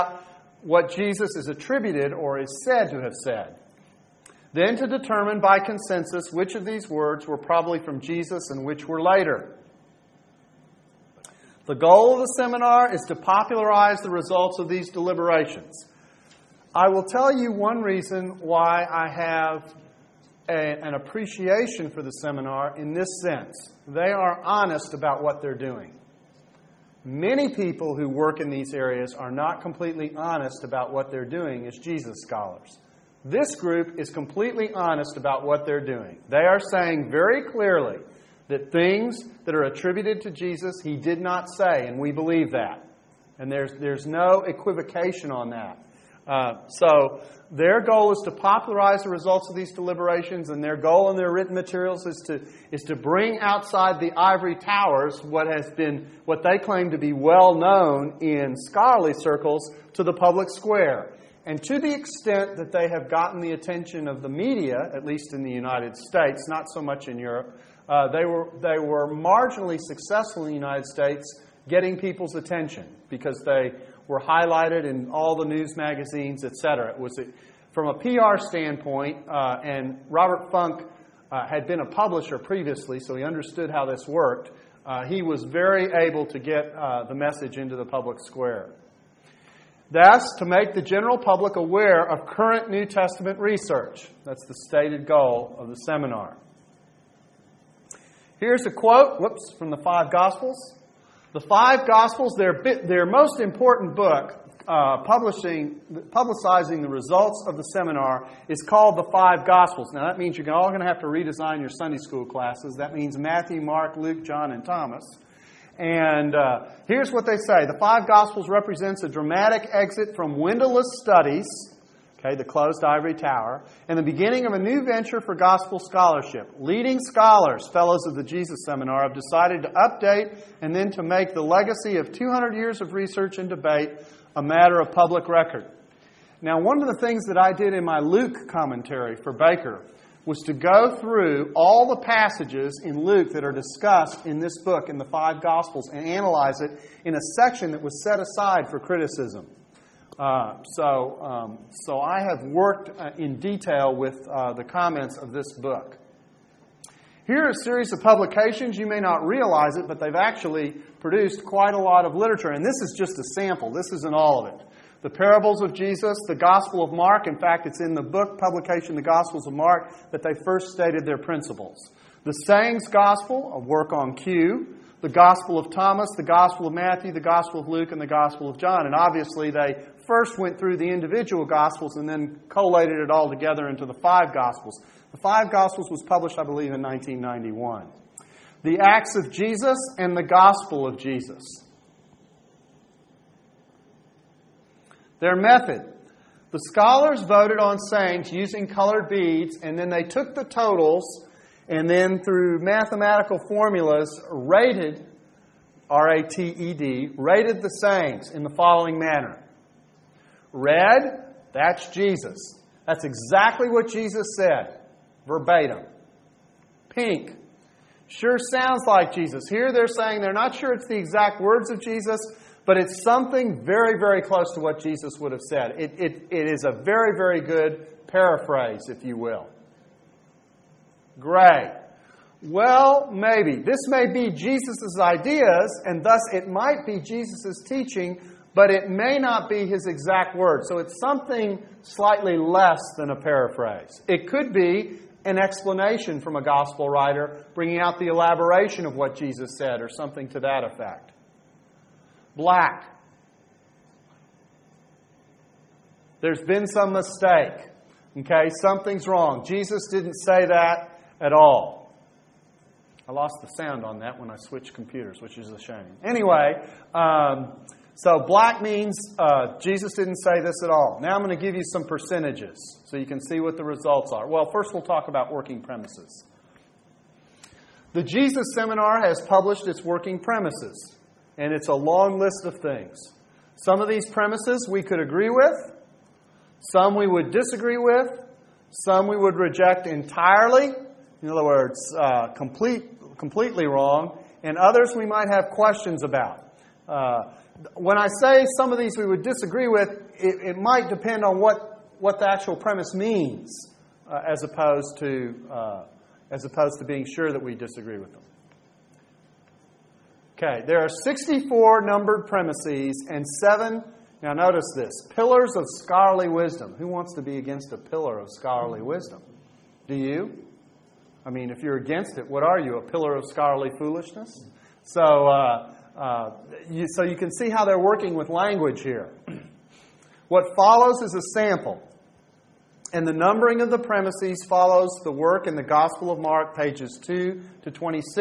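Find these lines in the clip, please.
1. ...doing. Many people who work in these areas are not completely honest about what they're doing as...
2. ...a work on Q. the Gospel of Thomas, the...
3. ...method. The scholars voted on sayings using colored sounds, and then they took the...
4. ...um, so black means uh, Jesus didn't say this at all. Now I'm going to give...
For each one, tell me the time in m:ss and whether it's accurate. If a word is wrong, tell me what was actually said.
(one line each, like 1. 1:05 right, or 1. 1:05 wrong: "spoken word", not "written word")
1. 0:25 right
2. 2:53 right
3. 3:15 wrong: "beads", not "sounds"
4. 4:26 right.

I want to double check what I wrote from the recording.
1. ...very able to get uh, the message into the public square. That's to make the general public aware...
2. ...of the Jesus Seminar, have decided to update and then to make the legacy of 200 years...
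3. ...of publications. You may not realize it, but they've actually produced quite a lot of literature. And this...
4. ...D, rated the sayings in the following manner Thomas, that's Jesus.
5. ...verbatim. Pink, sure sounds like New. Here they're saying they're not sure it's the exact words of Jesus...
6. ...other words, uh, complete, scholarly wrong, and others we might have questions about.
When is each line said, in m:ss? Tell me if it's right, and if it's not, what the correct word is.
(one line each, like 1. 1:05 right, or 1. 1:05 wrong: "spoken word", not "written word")
1. 1:25 right
2. 2:08 right
3. 2:37 right
4. 3:26 wrong: "Red", not "Thomas"
5. 3:35 wrong: "Jesus", not "New"
6. 4:51 wrong: "completely", not "scholarly".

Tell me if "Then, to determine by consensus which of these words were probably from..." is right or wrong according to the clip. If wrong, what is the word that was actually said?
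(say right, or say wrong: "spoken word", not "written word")
right.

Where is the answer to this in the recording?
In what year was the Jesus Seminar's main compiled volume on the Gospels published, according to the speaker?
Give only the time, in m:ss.
3:06.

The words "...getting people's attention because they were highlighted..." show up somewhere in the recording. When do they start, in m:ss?
1:11.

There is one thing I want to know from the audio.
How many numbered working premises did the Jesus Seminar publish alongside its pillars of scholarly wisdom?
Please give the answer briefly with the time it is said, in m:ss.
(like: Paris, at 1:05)
64, at 5:11.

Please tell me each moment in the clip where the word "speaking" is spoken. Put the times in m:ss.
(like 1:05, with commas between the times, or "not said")
not said.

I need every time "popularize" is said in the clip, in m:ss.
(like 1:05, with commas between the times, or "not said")
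0:13, 0:48.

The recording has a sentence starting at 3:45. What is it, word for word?
It, it, it is a very, very good paraphrase, if you will.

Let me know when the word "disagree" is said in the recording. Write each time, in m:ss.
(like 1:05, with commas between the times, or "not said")
4:47, 4:59, 5:07.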